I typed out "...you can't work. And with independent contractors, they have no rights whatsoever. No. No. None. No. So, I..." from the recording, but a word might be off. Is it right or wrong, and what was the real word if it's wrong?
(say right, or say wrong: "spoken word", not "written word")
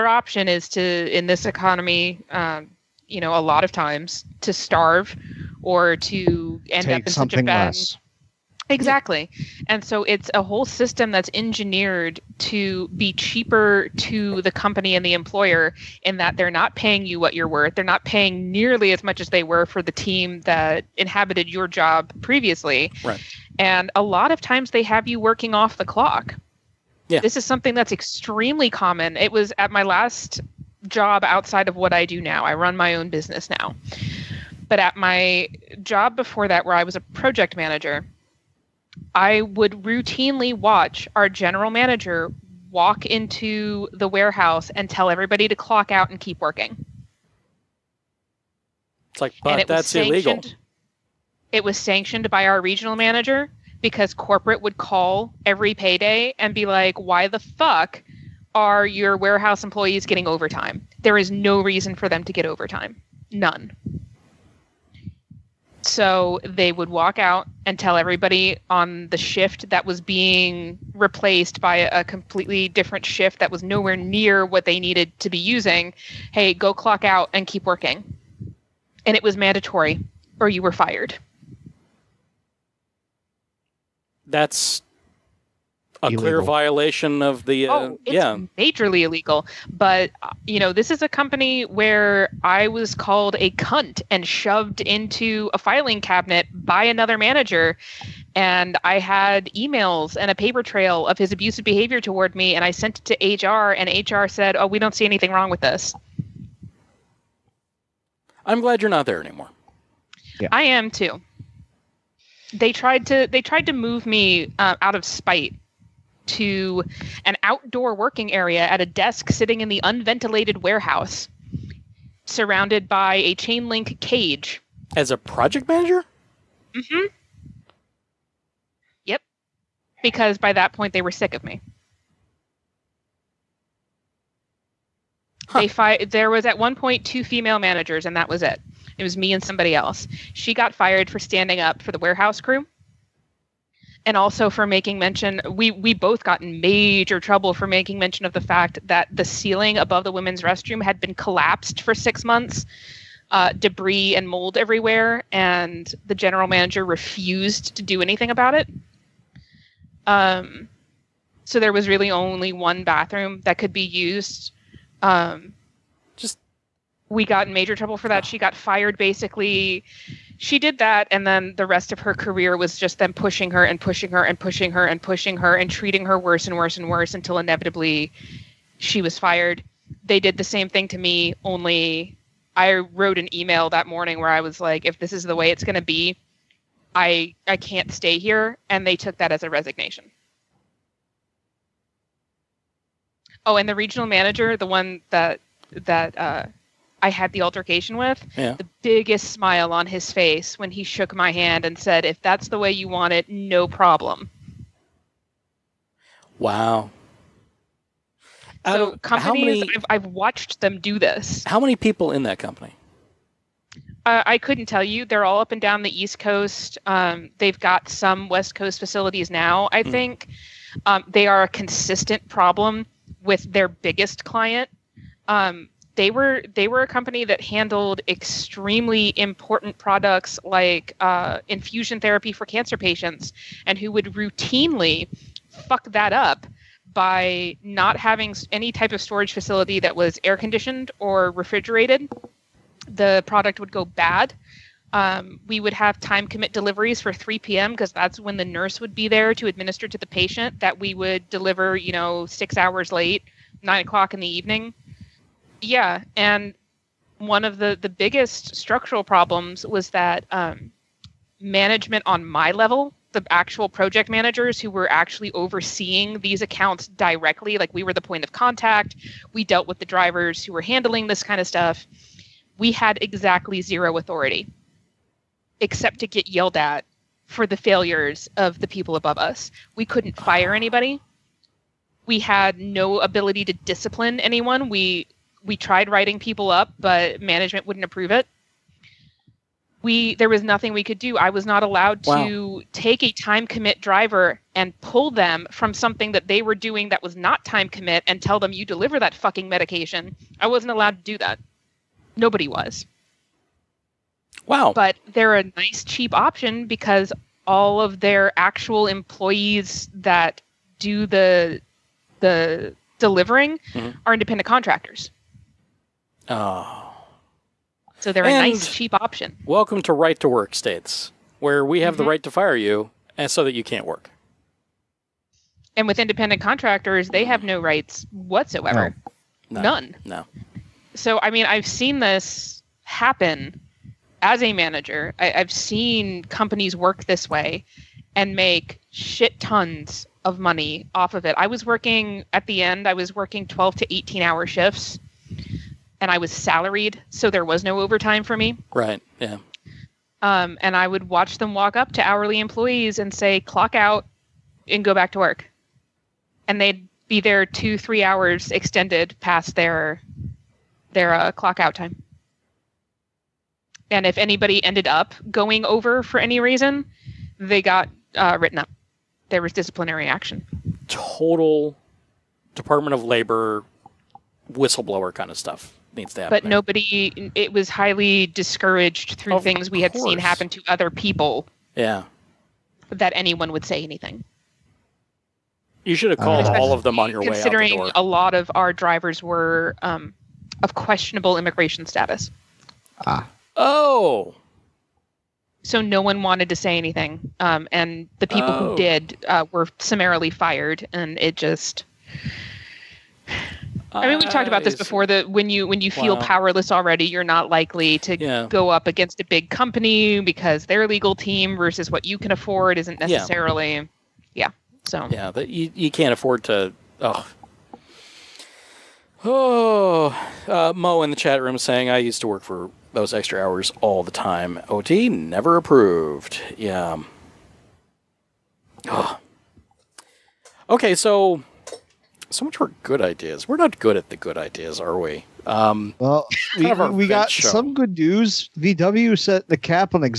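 right.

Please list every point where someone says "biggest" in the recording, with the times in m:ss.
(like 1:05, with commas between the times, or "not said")
3:18, 3:43, 4:17.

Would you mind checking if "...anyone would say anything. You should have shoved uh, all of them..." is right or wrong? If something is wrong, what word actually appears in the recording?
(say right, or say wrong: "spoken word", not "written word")
wrong: "called", not "shoved".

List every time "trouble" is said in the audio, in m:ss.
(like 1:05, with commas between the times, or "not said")
2:27, 2:47.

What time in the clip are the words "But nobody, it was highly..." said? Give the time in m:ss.
6:16.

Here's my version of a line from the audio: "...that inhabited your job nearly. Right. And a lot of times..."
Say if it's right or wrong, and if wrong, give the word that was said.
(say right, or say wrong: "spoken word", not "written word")
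wrong: "previously", not "nearly".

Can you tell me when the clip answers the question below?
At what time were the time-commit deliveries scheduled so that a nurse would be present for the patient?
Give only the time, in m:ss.
4:07.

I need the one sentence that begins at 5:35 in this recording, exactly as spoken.
I, I've seen companies work this way and make shit tons of money off of it.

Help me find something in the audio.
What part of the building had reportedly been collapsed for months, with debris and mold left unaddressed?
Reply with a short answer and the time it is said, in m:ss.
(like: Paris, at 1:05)
ceiling above the women's restroom, at 2:29.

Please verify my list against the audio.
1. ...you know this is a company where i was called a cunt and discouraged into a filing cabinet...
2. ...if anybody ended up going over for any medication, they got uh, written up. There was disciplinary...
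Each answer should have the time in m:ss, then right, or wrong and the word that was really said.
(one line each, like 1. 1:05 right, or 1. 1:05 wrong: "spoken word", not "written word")
1. 1:30 wrong: "shoved", not "discouraged"
2. 6:04 wrong: "reason", not "medication".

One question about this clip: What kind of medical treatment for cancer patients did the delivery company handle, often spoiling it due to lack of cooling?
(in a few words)
infusion therapy.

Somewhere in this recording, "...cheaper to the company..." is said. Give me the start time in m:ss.
0:13.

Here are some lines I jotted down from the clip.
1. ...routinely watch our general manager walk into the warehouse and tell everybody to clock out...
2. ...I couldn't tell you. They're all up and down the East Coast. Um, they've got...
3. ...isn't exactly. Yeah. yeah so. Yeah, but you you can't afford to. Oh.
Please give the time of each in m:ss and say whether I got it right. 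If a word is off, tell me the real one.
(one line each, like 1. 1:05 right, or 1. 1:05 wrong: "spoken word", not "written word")
1. 0:39 right
2. 3:34 right
3. 6:52 wrong: "necessarily", not "exactly".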